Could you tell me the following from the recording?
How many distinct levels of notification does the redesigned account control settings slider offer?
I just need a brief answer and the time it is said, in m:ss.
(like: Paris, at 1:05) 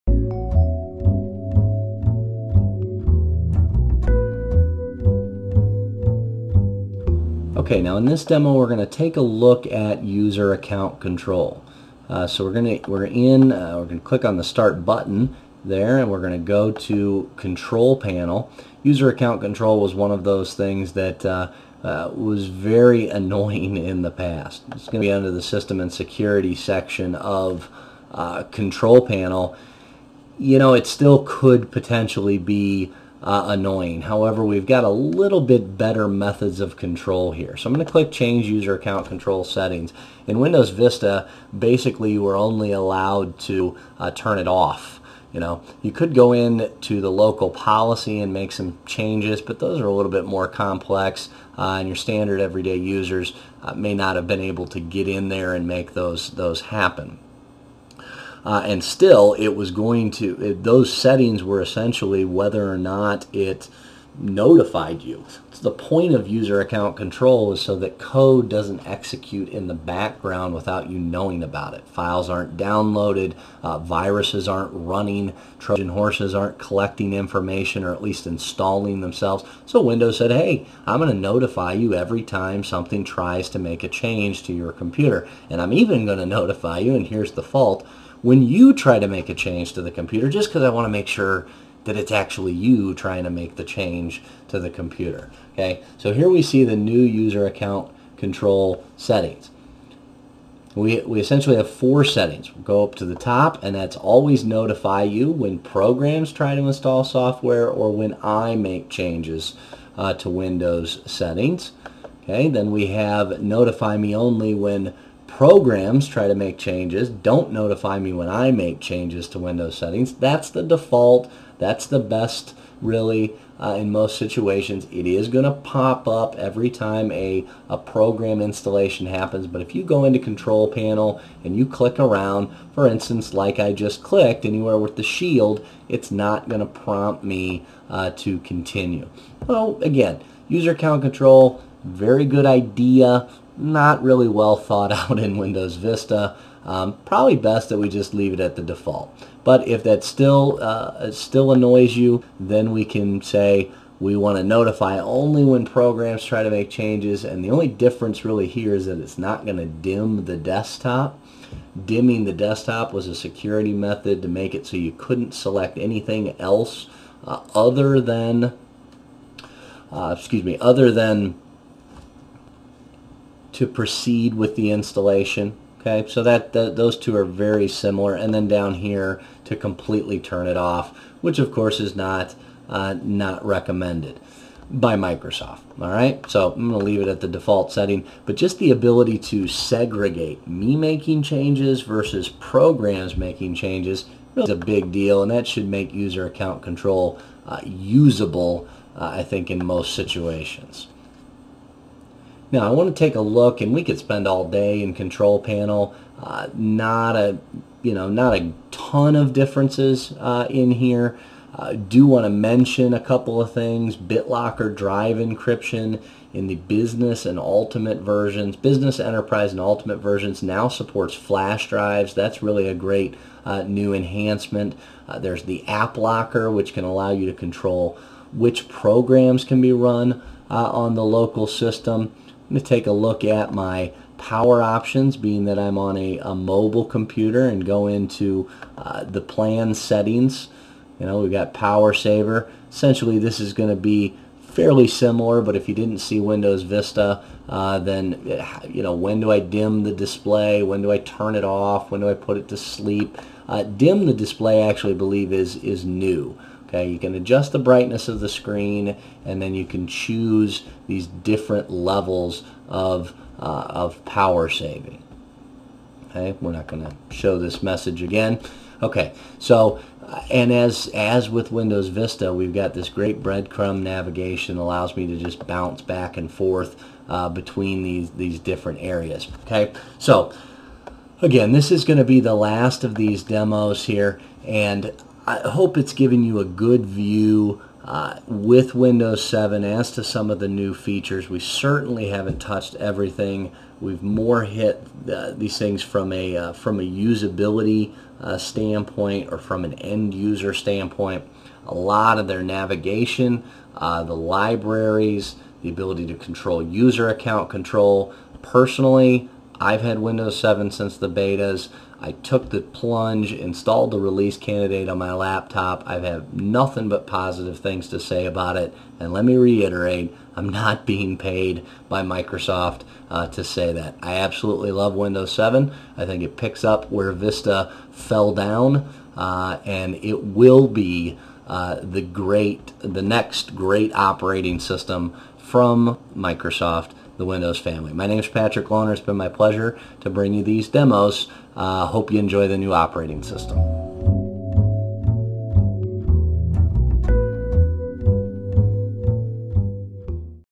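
4, at 1:41.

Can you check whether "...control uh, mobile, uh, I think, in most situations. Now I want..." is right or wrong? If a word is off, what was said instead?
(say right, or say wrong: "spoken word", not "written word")
wrong: "usable", not "mobile".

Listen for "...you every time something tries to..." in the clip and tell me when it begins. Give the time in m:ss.
1:21.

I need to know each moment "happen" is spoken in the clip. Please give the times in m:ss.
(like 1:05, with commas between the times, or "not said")
0:56, 2:09.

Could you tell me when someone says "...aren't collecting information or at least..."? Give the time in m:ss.
1:16.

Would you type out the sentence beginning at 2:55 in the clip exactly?
Okay, so that, those two are very similar.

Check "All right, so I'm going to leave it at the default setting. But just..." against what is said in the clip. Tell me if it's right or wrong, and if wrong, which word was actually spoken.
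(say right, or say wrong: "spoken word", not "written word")
right.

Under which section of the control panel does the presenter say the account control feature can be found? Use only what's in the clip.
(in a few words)
System and Security.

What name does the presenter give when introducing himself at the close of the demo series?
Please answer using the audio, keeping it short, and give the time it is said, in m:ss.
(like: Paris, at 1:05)
Patrick Lohner, at 5:38.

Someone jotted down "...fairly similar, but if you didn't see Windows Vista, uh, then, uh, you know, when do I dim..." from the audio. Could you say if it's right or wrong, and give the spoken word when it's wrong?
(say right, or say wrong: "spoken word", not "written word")
right.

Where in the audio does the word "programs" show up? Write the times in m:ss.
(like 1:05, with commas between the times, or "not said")
1:45, 1:55, 2:07, 2:35, 3:12, 3:48.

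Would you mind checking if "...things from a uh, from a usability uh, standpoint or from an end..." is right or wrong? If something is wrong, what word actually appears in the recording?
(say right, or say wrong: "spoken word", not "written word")
right.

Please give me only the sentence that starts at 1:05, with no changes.
So the point of user account control is so that code doesn't execute in the background without you knowing about it.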